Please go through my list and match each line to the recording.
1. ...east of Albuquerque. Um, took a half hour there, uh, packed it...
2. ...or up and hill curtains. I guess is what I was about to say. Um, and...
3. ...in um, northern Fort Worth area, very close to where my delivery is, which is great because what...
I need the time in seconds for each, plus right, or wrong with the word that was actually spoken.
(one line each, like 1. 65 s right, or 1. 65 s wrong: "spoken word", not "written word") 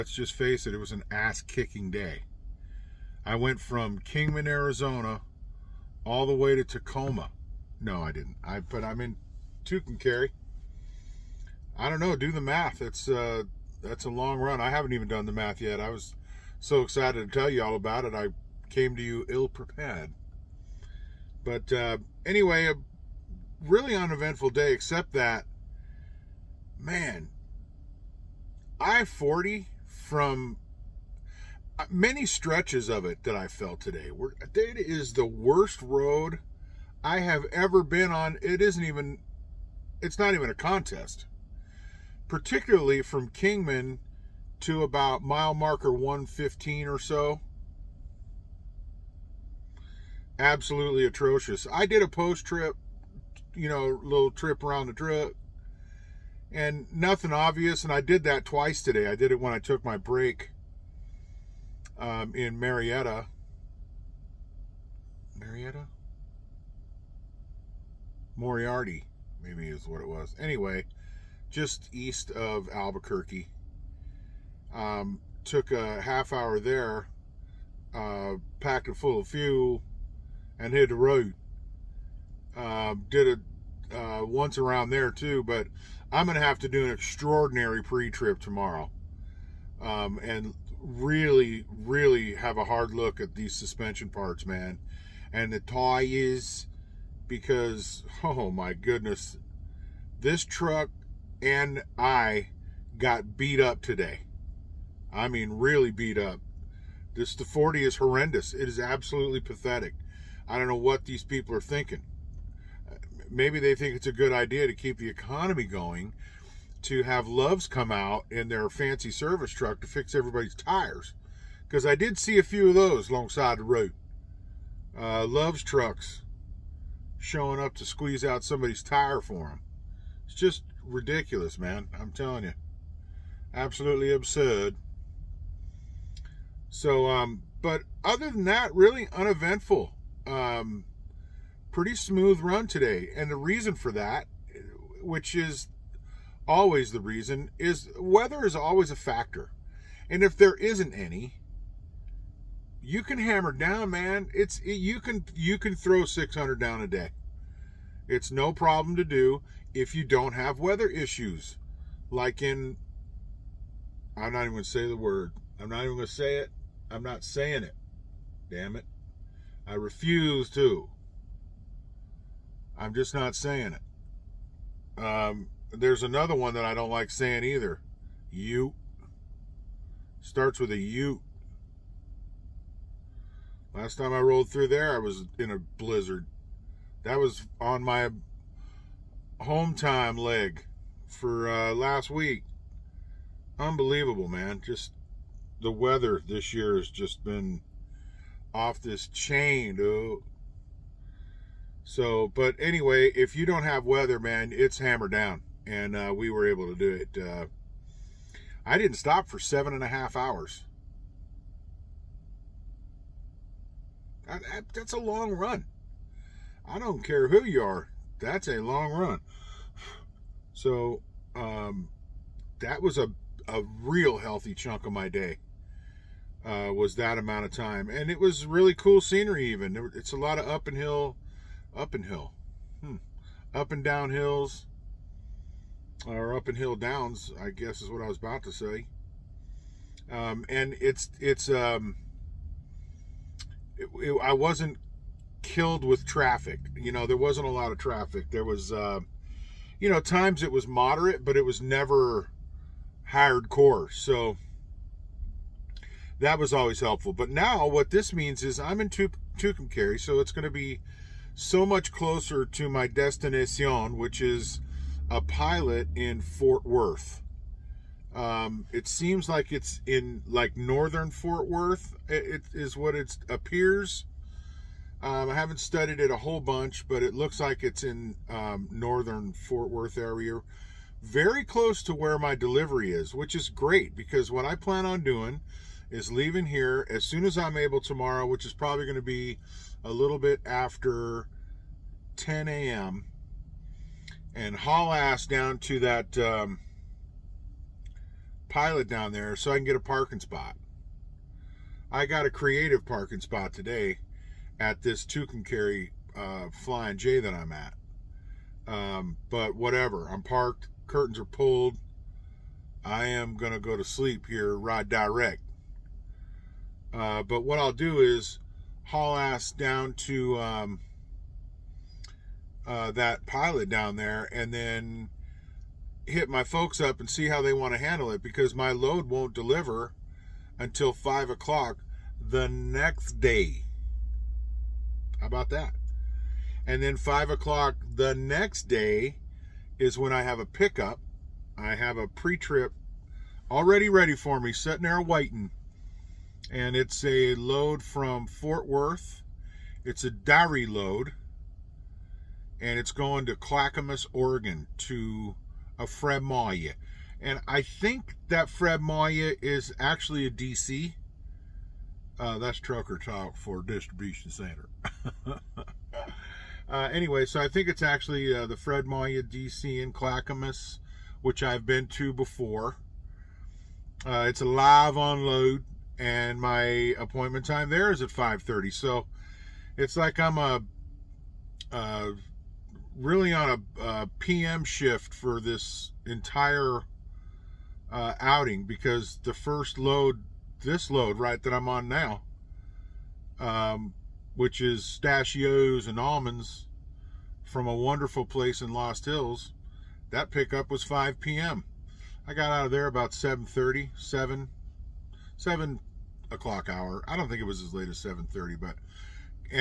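1. 71 s right
2. 236 s wrong: "downs", not "curtains"
3. 277 s right.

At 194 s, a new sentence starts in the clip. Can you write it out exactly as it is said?
Just the weather this year has just been off this chain, dude.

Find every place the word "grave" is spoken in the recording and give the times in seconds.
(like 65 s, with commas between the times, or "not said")
not said.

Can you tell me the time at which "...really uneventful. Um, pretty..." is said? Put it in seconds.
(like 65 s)
138 s.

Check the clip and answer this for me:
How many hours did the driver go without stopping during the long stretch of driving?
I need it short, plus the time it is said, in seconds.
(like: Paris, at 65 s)
7.5, at 209 s.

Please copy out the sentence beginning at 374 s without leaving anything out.
Uh, it's a live unload, and my appointment time there is at 5.30.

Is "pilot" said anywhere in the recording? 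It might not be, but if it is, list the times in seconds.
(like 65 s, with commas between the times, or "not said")
265 s, 298 s, 323 s.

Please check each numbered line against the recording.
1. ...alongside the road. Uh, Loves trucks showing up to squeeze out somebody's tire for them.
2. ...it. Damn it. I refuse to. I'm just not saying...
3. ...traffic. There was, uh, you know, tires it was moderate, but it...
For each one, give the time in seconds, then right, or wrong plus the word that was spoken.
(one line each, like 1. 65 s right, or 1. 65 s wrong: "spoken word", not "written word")
1. 123 s right
2. 167 s right
3. 247 s wrong: "times", not "tires".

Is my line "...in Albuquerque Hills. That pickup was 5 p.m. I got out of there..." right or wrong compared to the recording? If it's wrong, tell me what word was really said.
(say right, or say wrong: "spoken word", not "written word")
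wrong: "Lost", not "Albuquerque".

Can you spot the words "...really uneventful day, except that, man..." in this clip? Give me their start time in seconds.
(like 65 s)
23 s.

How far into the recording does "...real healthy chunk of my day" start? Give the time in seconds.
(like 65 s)
223 s.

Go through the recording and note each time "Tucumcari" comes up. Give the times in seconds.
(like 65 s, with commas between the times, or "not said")
9 s, 258 s, 305 s.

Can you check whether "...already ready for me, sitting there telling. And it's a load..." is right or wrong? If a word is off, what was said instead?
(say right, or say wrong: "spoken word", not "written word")
wrong: "waiting", not "telling".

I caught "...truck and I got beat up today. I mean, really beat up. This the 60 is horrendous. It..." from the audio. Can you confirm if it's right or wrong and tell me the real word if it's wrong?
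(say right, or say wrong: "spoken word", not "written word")
wrong: "40", not "60".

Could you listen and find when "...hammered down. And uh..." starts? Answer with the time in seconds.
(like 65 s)
204 s.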